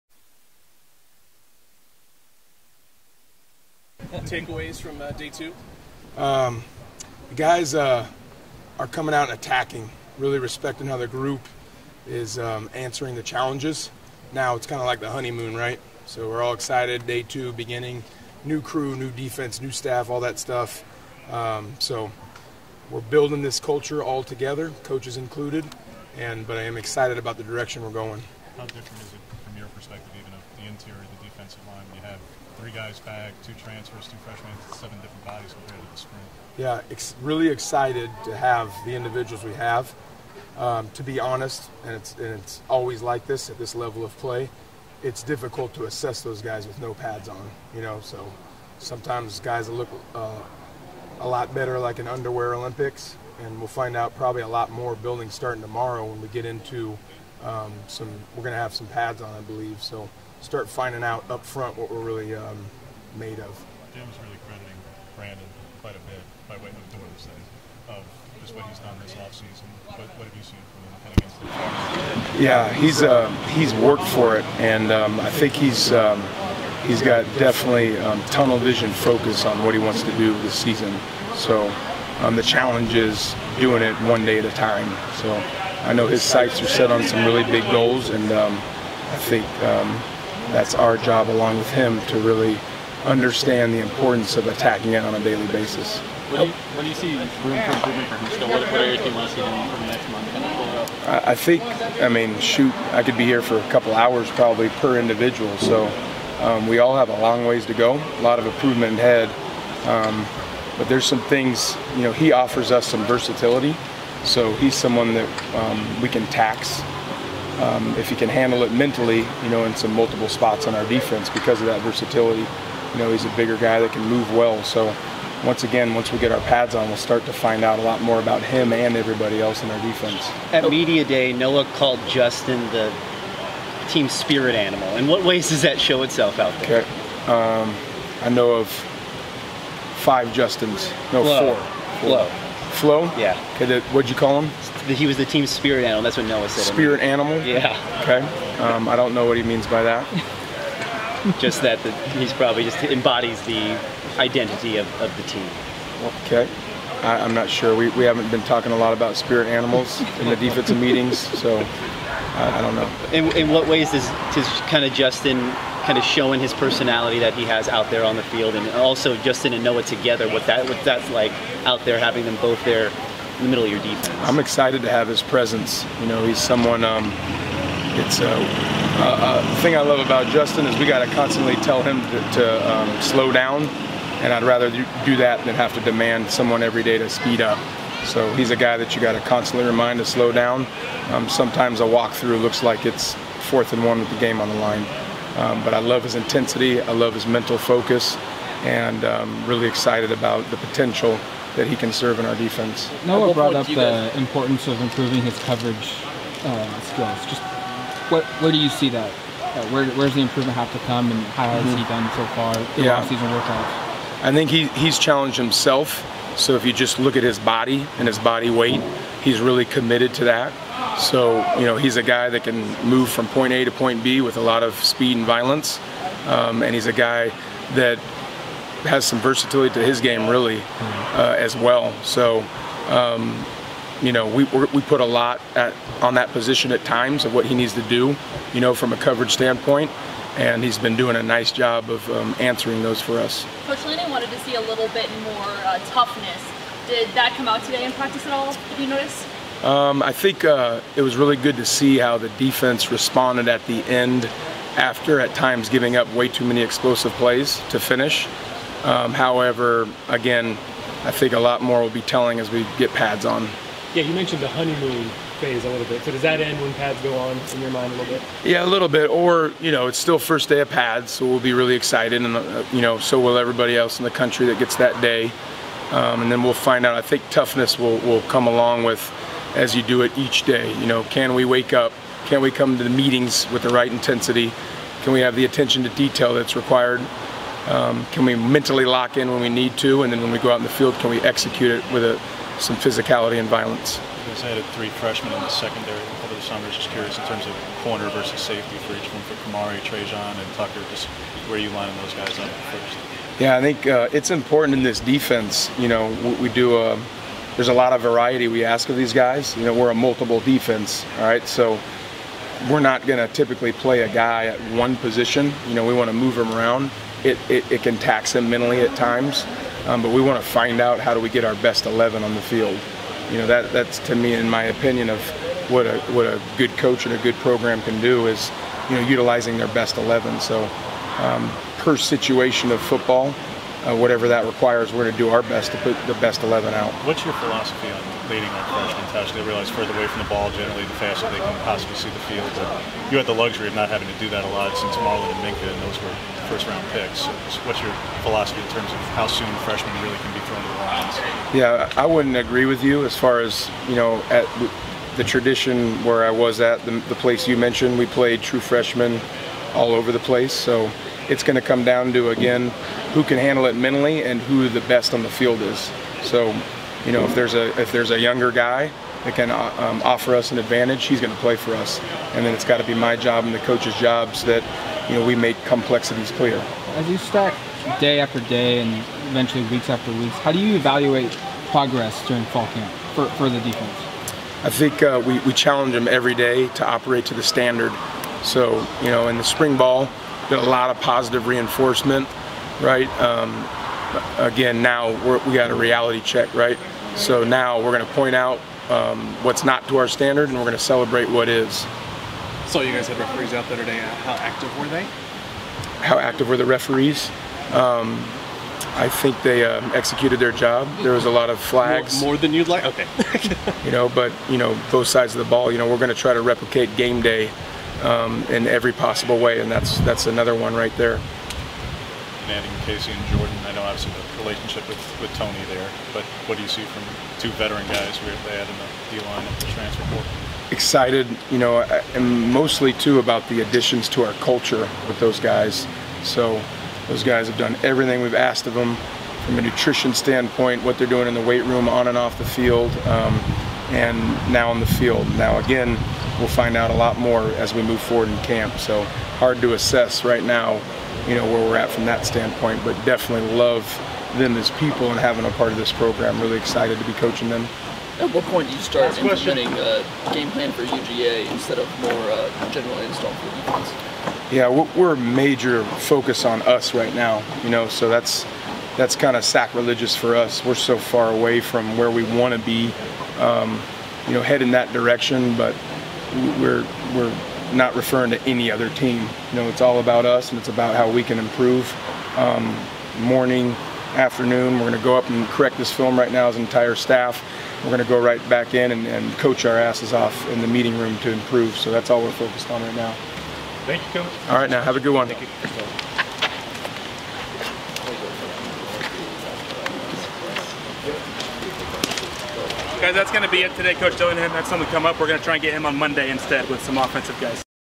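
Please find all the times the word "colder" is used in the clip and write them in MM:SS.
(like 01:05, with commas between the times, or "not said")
not said.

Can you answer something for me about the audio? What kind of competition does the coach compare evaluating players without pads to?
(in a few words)
underwear Olympics.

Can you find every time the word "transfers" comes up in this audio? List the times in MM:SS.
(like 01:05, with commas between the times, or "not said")
00:33, 07:09.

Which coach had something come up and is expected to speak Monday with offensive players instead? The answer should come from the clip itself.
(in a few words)
Coach Dillingham.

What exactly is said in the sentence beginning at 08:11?
So that's all we're focused on right now.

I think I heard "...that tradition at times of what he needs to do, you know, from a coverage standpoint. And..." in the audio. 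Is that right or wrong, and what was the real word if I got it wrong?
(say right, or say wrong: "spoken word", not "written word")
wrong: "position", not "tradition".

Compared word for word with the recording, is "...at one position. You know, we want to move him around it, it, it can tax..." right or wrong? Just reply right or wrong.
right.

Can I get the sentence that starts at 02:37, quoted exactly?
We, we haven't been talking a lot about spirit animals in the defensive meetings, so I, I, don't know.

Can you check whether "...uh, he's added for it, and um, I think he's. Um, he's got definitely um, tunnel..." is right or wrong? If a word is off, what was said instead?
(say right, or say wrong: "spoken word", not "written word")
wrong: "worked", not "added".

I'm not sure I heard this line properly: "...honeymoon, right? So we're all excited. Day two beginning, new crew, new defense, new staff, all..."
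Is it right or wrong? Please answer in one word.
right.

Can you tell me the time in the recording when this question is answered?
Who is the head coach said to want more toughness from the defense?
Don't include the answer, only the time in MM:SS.
04:03.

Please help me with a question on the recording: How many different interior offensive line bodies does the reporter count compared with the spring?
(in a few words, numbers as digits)
7.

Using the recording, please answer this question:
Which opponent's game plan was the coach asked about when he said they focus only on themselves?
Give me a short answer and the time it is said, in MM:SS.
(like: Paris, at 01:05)
UGA, at 07:40.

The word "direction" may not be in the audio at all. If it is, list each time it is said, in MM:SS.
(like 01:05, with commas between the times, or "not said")
00:27, 07:54.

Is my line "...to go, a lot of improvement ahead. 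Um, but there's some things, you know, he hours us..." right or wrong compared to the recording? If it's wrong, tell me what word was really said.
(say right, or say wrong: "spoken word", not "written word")
wrong: "offers", not "hours".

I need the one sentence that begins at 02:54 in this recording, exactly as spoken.
I'm excited to have his presence.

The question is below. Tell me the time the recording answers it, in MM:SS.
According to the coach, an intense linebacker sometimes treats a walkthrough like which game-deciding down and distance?
03:13.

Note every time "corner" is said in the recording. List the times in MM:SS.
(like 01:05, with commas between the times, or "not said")
04:57.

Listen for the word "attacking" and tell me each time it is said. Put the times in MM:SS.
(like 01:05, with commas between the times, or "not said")
00:09, 01:34.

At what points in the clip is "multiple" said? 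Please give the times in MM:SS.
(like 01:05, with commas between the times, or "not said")
01:59, 05:09.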